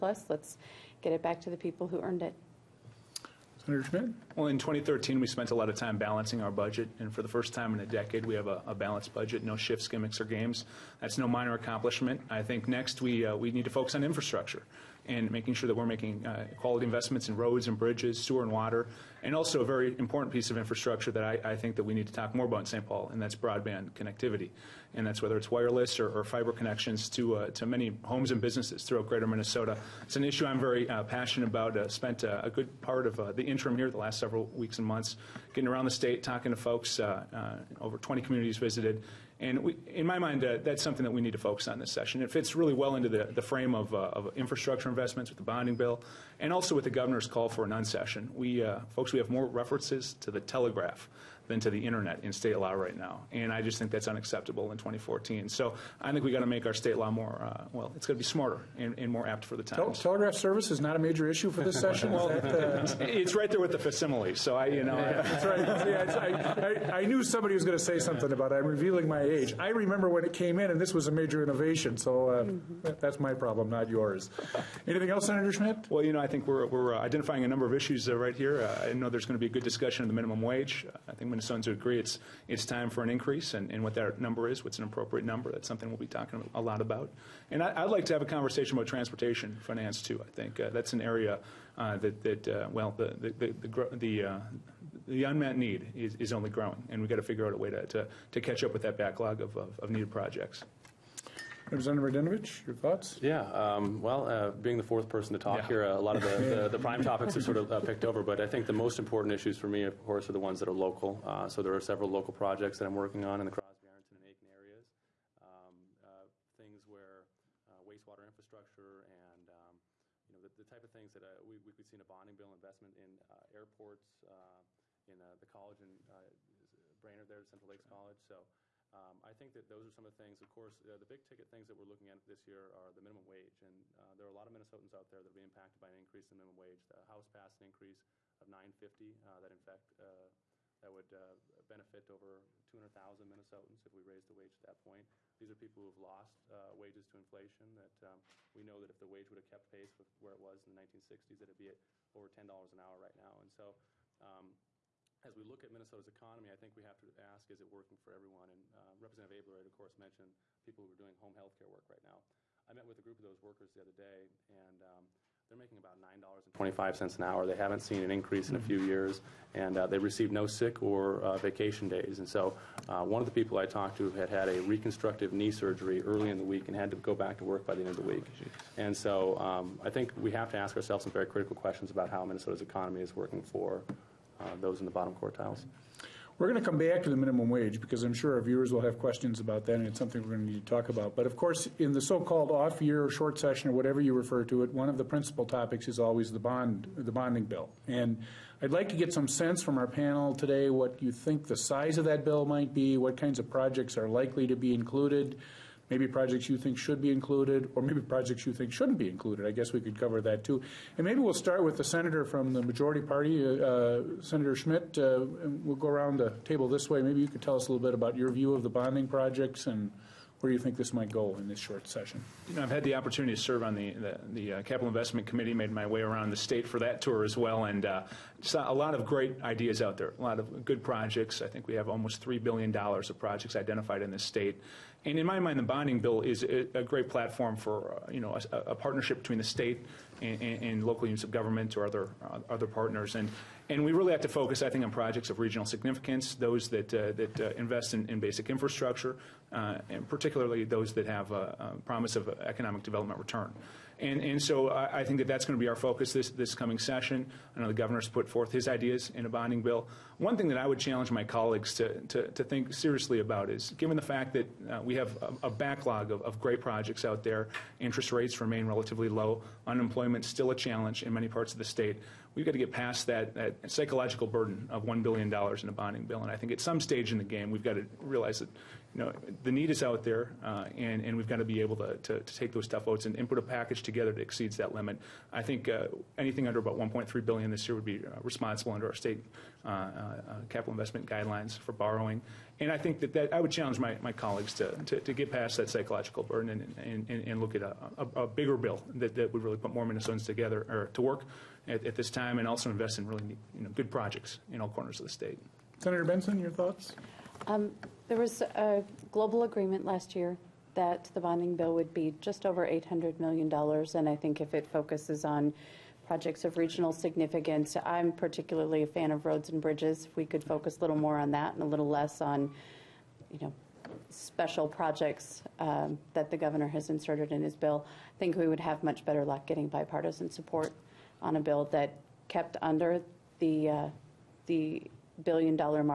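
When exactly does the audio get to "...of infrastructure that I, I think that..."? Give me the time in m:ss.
0:20.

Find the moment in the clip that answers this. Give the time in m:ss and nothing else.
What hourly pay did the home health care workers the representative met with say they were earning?
2:45.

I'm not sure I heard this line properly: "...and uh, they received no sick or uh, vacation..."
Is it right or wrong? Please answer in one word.
right.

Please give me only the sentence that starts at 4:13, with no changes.
And, and so I, I think that that's going to be our focus this, this coming session.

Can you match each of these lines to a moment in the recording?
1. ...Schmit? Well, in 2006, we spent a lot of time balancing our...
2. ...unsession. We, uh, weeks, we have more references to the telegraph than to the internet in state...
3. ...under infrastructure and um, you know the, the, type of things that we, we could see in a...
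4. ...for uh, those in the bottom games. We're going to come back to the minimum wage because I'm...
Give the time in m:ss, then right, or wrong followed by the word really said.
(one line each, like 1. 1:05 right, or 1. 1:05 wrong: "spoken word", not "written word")
1. 0:03 wrong: "2013", not "2006"
2. 0:47 wrong: "folks", not "weeks"
3. 1:57 wrong: "wastewater", not "under"
4. 3:03 wrong: "quartiles", not "games".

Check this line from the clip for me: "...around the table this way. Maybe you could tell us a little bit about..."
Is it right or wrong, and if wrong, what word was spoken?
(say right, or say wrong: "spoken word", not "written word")
right.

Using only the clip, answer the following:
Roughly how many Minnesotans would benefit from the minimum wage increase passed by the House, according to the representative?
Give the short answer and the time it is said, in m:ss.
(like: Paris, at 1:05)
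over 200,000, at 2:22.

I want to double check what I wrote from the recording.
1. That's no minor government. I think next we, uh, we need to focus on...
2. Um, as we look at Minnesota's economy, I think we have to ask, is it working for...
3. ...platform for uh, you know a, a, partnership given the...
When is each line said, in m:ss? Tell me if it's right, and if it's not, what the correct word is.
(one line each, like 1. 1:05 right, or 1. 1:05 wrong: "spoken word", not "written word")
1. 0:10 wrong: "accomplishment", not "government"
2. 2:34 right
3. 3:57 wrong: "between", not "given".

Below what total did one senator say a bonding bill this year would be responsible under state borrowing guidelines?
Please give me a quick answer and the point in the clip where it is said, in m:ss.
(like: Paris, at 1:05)
1.3 billion, at 4:46.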